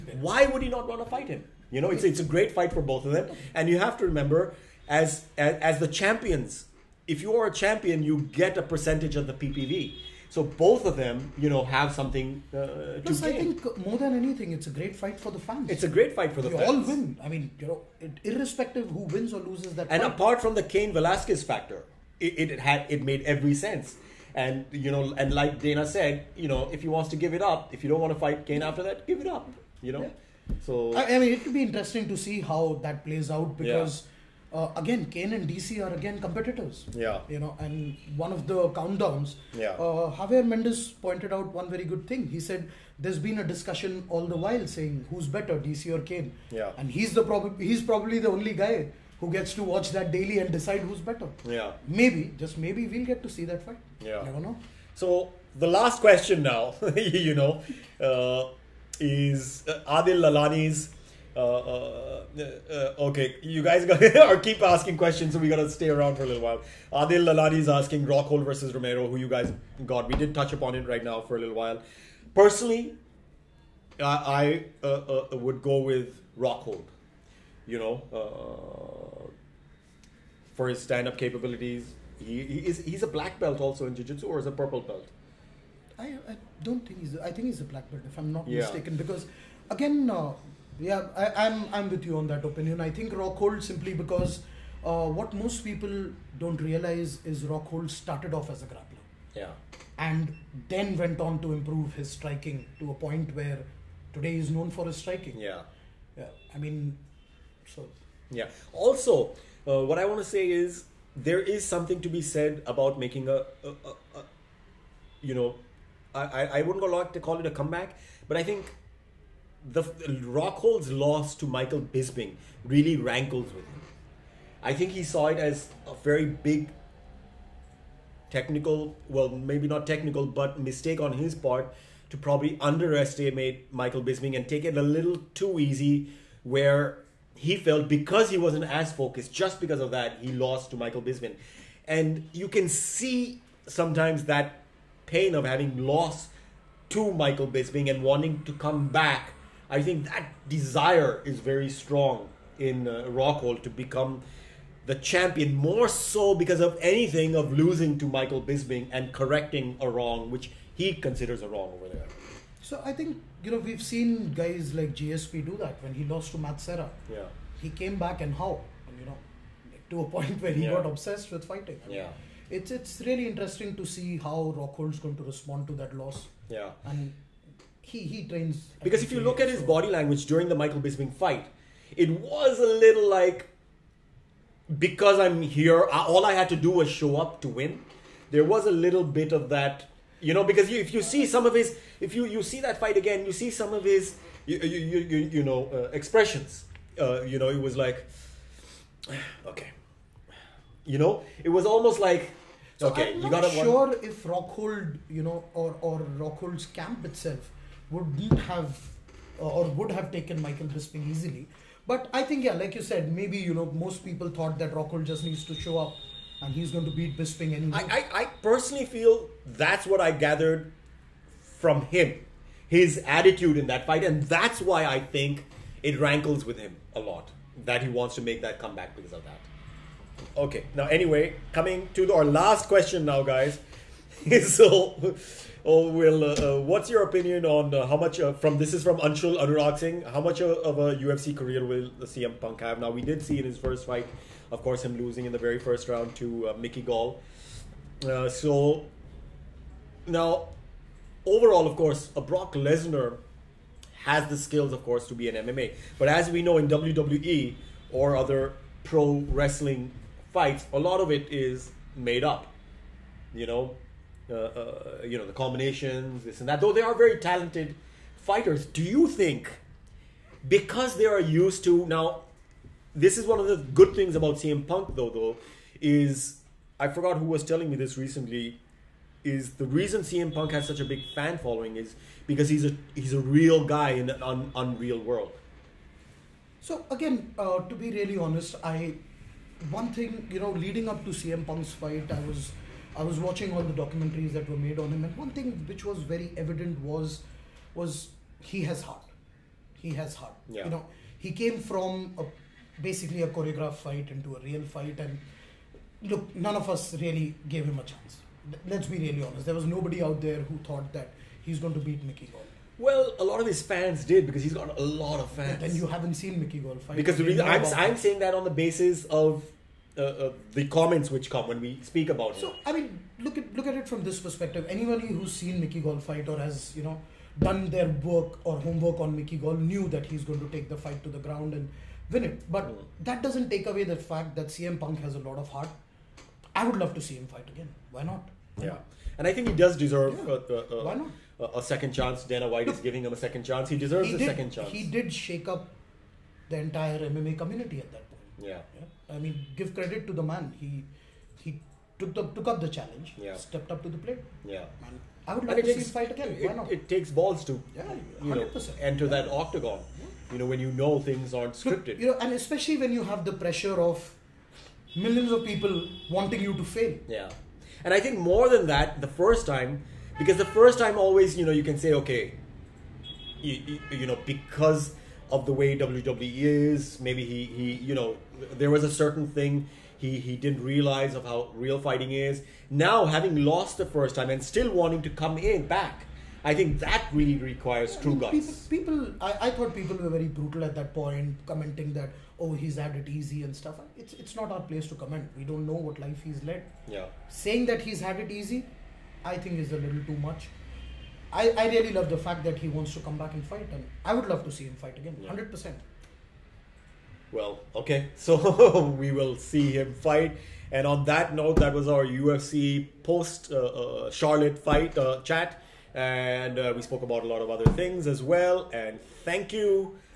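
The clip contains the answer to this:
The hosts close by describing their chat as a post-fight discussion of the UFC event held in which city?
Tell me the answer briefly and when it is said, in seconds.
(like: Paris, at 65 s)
Charlotte, at 414 s.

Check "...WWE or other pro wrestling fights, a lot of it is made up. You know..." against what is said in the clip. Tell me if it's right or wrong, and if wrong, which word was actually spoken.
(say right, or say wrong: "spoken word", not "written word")
right.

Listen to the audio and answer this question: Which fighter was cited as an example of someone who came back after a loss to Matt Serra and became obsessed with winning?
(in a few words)
GSP.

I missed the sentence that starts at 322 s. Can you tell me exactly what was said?
So I mean, look at look at it from this perspective.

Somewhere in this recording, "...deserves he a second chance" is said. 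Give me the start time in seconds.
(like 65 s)
343 s.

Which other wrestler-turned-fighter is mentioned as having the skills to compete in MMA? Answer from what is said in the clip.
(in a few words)
Brock Lesnar.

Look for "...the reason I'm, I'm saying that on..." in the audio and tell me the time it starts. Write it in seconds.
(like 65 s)
317 s.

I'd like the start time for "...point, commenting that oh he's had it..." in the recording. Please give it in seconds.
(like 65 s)
390 s.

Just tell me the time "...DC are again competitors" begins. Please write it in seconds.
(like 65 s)
35 s.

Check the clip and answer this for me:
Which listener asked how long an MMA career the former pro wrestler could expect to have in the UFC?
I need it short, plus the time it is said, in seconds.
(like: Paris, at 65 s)
Anshul Anurag Singh, at 239 s.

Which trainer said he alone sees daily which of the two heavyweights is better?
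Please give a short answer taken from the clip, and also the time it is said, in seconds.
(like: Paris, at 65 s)
Javier Mendez, at 40 s.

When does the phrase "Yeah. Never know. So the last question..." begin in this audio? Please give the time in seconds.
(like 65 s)
53 s.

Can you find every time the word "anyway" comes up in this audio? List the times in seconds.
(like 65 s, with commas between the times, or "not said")
217 s, 230 s.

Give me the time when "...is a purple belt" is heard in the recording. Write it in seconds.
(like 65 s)
84 s.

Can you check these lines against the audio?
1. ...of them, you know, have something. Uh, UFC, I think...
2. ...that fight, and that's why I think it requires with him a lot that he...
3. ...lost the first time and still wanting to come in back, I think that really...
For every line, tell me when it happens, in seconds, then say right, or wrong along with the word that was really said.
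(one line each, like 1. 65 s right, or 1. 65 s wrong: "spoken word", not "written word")
1. 10 s wrong: "Plus", not "UFC"
2. 223 s wrong: "rankles", not "requires"
3. 383 s right.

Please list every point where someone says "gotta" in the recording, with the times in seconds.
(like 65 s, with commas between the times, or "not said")
65 s, 203 s.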